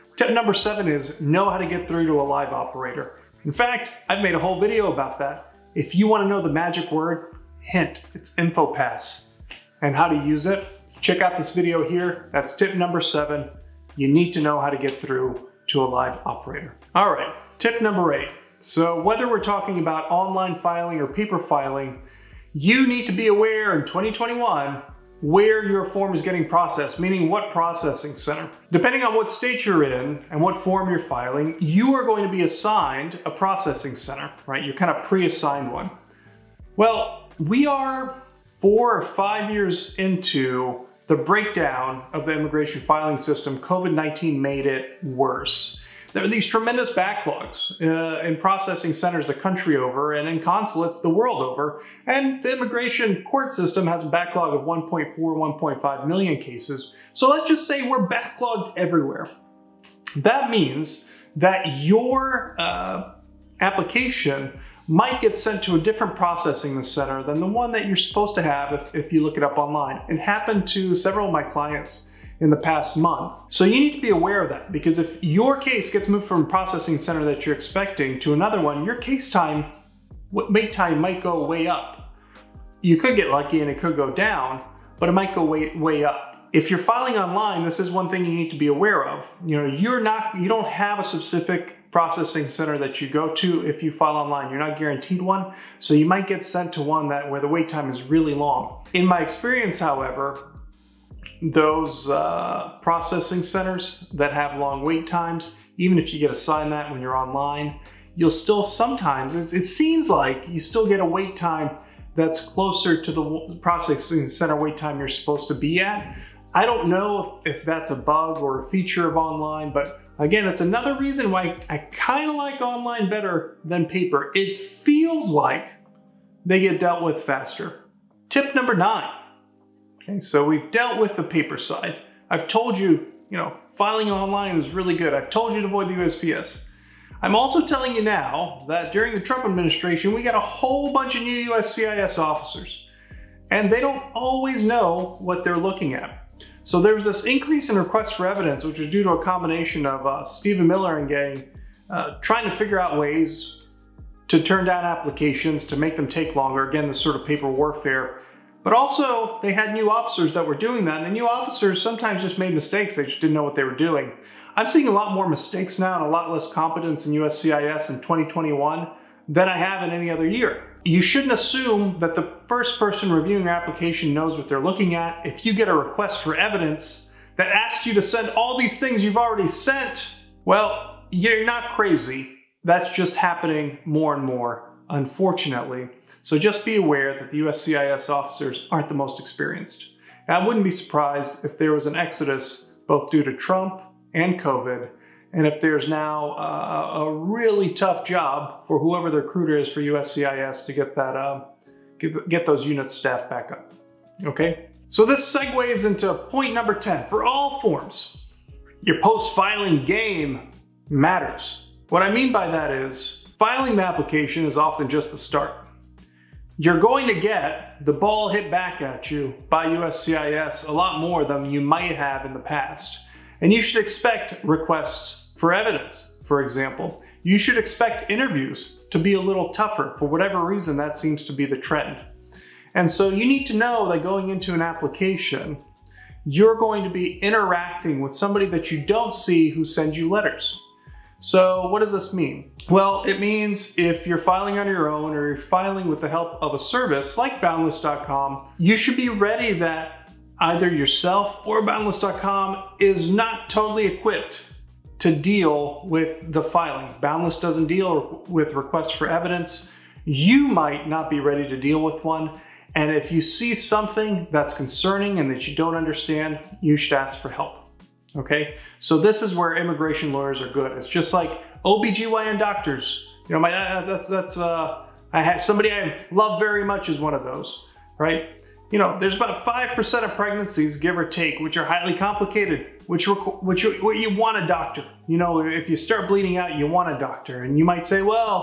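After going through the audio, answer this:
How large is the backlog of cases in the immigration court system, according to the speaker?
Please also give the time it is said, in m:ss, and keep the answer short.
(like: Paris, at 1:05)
1.4 to 1.5 million cases, at 0:54.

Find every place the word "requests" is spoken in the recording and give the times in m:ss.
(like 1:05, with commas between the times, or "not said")
2:27, 2:55, 3:44, 4:18.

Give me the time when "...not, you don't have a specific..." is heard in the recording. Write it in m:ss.
1:29.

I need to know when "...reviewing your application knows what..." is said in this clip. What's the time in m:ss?
2:53.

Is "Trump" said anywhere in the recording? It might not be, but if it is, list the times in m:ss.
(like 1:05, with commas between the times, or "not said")
2:19, 3:13.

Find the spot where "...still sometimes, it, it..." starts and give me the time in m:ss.
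1:48.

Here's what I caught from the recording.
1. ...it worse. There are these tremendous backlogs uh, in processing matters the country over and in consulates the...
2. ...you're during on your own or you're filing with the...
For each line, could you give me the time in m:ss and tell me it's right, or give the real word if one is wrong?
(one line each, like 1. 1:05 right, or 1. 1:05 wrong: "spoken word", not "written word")
1. 0:44 wrong: "centers", not "matters"
2. 4:04 wrong: "filing", not "during".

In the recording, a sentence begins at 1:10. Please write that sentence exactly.
It happened to several of my clients in the past month.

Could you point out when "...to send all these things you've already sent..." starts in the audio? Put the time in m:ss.
2:57.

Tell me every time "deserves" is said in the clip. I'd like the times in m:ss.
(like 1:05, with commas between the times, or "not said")
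not said.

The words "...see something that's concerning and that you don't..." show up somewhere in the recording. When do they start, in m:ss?
4:23.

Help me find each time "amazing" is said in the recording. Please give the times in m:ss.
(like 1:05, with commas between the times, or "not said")
not said.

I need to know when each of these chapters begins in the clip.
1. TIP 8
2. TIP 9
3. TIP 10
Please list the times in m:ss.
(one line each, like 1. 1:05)
1. 0:23
2. 2:18
3. 3:23.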